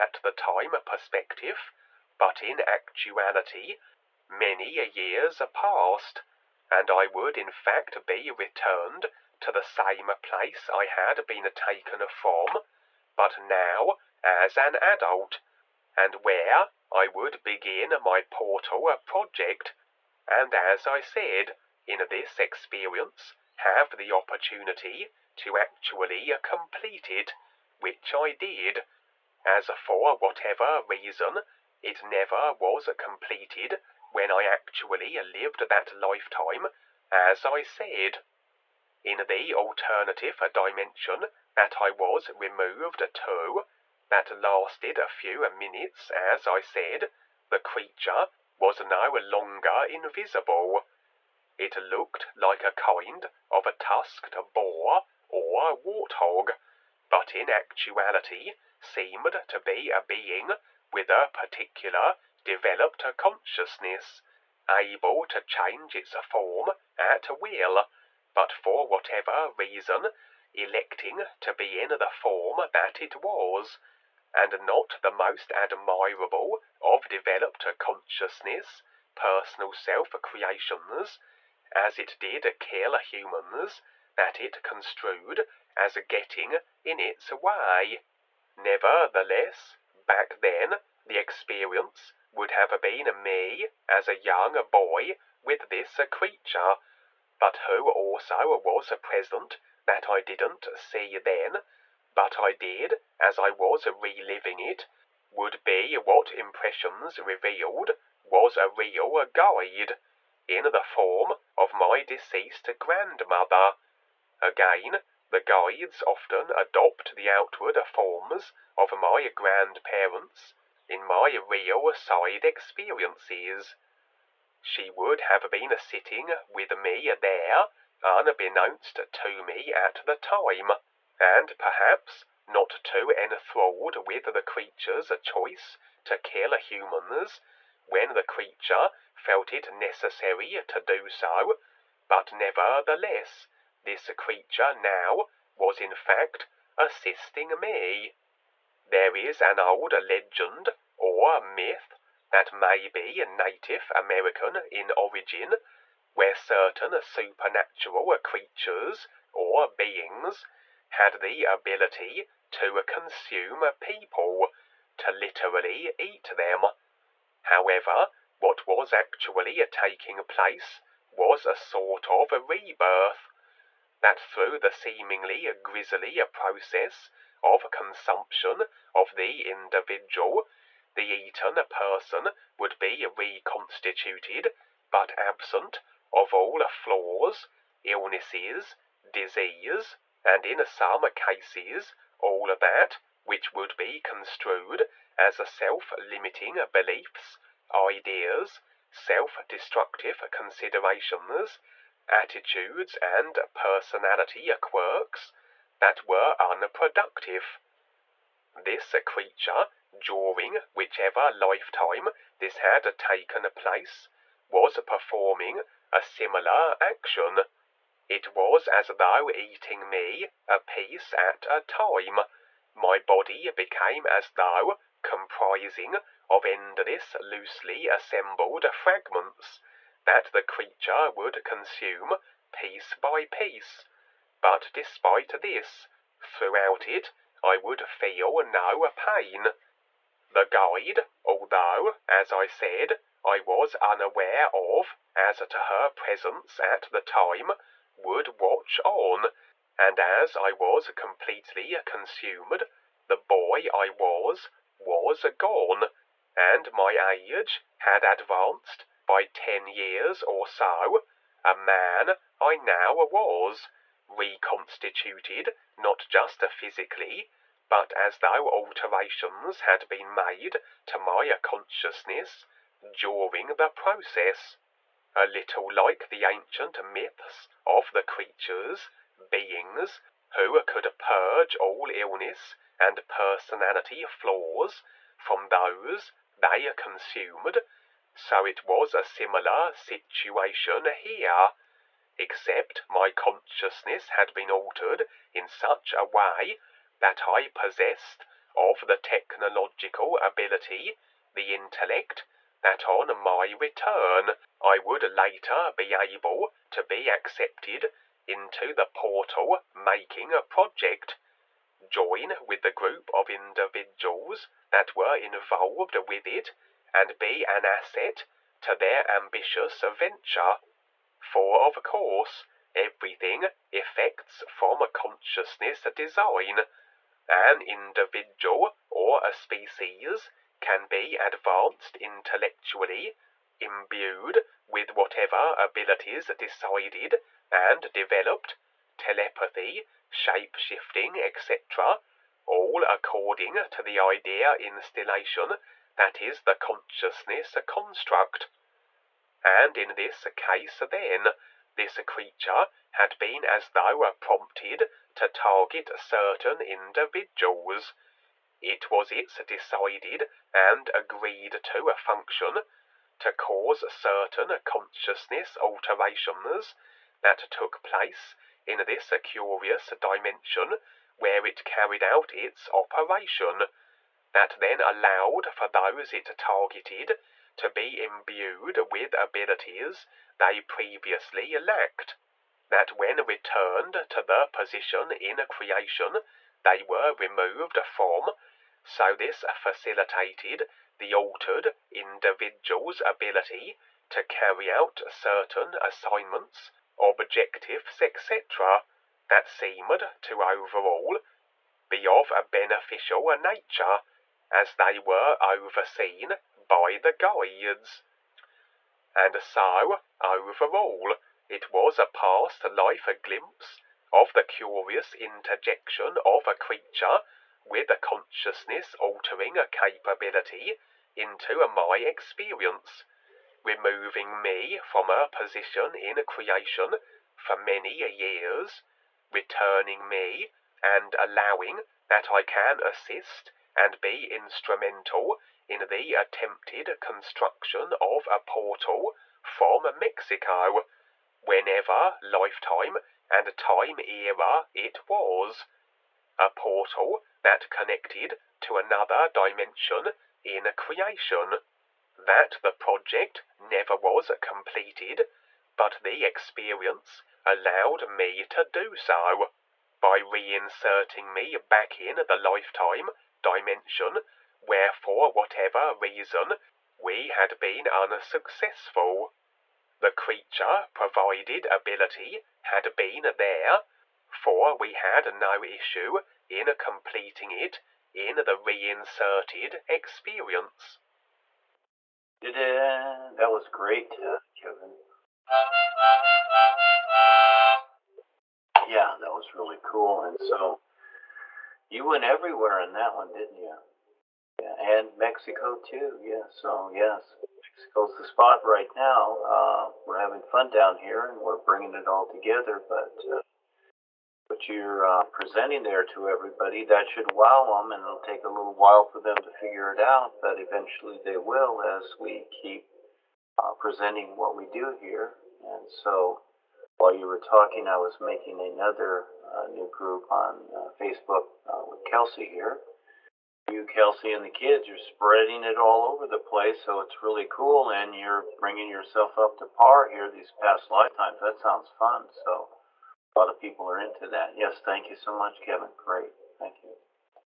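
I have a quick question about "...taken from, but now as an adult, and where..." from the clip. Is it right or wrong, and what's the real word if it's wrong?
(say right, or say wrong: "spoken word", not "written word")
right.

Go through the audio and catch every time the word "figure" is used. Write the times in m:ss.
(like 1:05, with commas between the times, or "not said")
8:29.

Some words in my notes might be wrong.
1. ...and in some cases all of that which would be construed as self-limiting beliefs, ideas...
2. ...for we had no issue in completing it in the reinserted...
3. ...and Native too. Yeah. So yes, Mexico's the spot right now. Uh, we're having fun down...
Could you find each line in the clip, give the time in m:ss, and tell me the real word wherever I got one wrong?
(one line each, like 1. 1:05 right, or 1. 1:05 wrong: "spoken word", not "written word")
1. 3:10 right
2. 7:54 right
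3. 8:14 wrong: "Mexico", not "Native".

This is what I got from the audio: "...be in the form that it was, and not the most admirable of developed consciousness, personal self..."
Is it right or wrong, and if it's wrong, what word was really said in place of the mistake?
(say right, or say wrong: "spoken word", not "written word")
right.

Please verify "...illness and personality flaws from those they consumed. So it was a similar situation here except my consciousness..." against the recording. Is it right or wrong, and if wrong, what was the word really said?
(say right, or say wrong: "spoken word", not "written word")
right.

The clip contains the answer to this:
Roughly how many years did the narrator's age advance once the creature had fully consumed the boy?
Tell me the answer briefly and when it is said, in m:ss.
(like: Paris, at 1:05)
10 years, at 4:19.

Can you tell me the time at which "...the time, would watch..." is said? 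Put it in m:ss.
4:06.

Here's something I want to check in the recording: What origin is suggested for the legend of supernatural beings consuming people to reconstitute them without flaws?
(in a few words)
Native American.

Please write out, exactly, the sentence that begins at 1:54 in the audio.
Again, the guides often adopt the outward forms of my grandparents in my real side experiences.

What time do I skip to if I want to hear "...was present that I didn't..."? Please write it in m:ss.
1:38.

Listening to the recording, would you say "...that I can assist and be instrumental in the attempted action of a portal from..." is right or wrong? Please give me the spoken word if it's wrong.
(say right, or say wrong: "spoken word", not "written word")
wrong: "construction", not "action".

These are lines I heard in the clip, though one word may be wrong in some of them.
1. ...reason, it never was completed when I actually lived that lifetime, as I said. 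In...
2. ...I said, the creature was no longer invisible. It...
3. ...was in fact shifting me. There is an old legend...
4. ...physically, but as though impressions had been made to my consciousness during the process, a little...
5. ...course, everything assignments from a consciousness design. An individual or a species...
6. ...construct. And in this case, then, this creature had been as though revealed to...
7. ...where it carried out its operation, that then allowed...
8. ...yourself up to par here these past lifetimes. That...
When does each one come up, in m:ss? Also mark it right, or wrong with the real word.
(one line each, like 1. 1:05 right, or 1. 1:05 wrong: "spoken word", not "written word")
1. 0:30 right
2. 0:46 right
3. 2:25 wrong: "assisting", not "shifting"
4. 4:26 wrong: "alterations", not "impressions"
5. 5:21 wrong: "effects", not "assignments"
6. 5:47 wrong: "prompted", not "revealed"
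7. 6:11 right
8. 8:48 right.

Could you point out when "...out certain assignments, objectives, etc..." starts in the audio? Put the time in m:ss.
6:34.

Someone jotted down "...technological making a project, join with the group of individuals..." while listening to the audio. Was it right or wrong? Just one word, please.
wrong.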